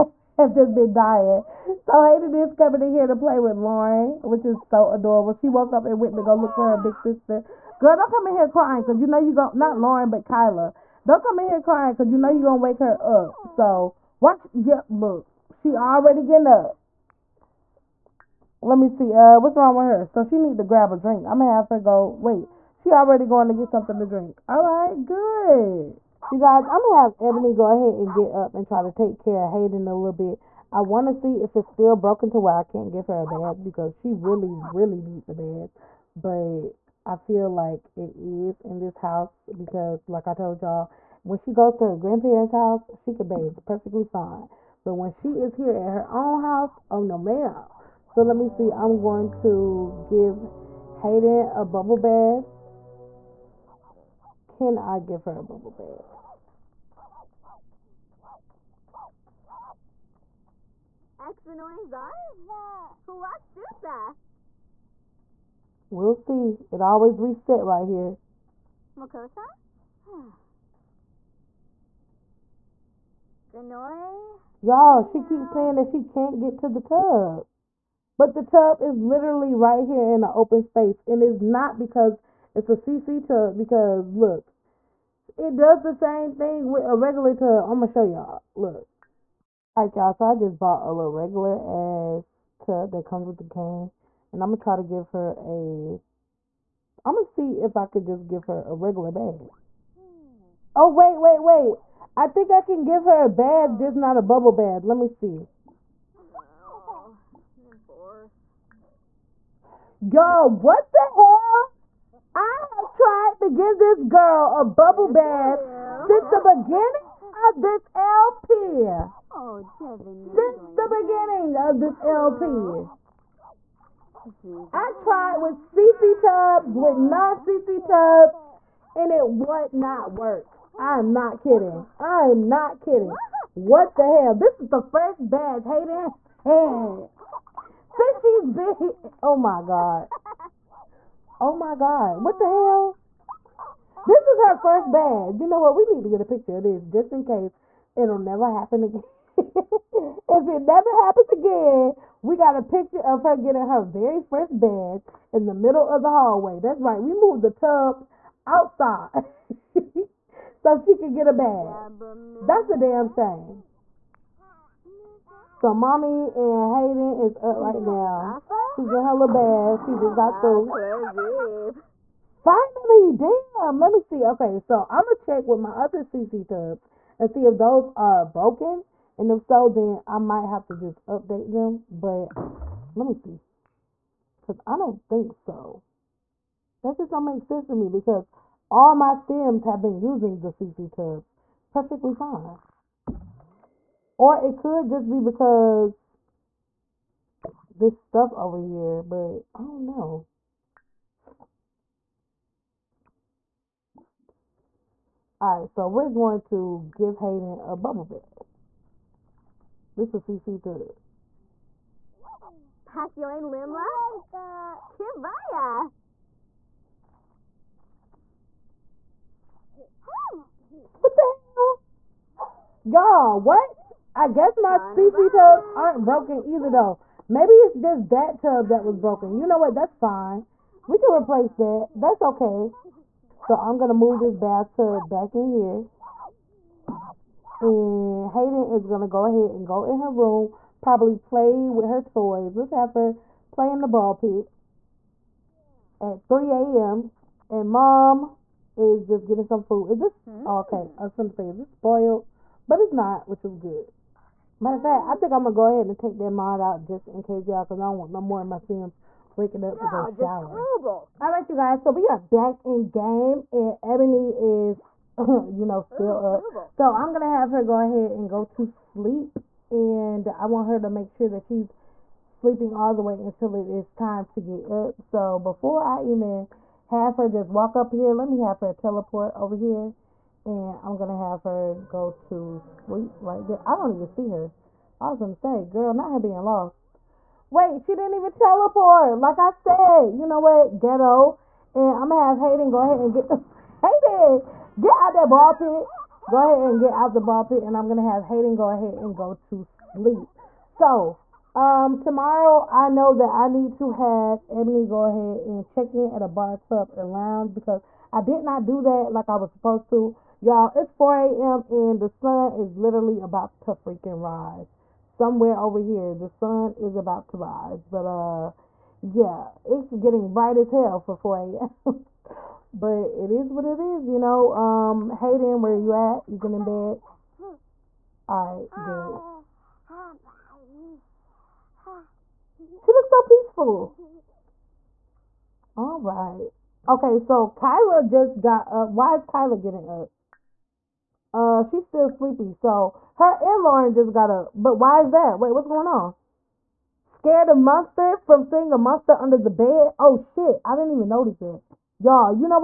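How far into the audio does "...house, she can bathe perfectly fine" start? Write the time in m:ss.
0:42.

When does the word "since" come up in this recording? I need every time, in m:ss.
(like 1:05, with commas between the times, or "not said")
1:56, 2:00, 2:17.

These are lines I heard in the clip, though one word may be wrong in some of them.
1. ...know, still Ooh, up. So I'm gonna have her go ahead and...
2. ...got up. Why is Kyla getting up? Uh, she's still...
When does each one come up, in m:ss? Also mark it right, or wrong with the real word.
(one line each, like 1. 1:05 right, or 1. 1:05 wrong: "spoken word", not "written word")
1. 4:25 right
2. 5:38 right.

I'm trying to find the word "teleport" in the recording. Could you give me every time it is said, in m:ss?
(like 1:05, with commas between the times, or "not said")
4:38, 4:48.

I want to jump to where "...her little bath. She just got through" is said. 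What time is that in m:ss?
2:49.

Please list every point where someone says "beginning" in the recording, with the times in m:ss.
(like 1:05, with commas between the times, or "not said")
1:56, 2:01.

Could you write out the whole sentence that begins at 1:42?
I think I can give her a bath, just not a bubble bath.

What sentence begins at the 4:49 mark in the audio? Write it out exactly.
Like I said, you know what?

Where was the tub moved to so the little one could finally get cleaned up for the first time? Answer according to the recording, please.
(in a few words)
the hallway.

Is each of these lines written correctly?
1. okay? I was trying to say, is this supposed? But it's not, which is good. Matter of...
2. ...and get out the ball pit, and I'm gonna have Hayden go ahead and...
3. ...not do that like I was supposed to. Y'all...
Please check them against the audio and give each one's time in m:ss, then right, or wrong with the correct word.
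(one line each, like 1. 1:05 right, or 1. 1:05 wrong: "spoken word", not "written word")
1. 4:10 wrong: "spoiled", not "supposed"
2. 4:56 right
3. 5:08 right.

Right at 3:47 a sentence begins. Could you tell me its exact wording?
Maybe it's just that tub that was broken.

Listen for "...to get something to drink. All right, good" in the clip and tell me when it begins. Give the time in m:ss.
0:23.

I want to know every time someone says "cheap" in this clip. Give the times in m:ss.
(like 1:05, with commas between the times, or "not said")
not said.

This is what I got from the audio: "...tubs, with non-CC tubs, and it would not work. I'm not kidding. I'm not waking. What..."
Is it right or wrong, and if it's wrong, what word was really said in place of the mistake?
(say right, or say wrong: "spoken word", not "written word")
wrong: "kidding", not "waking".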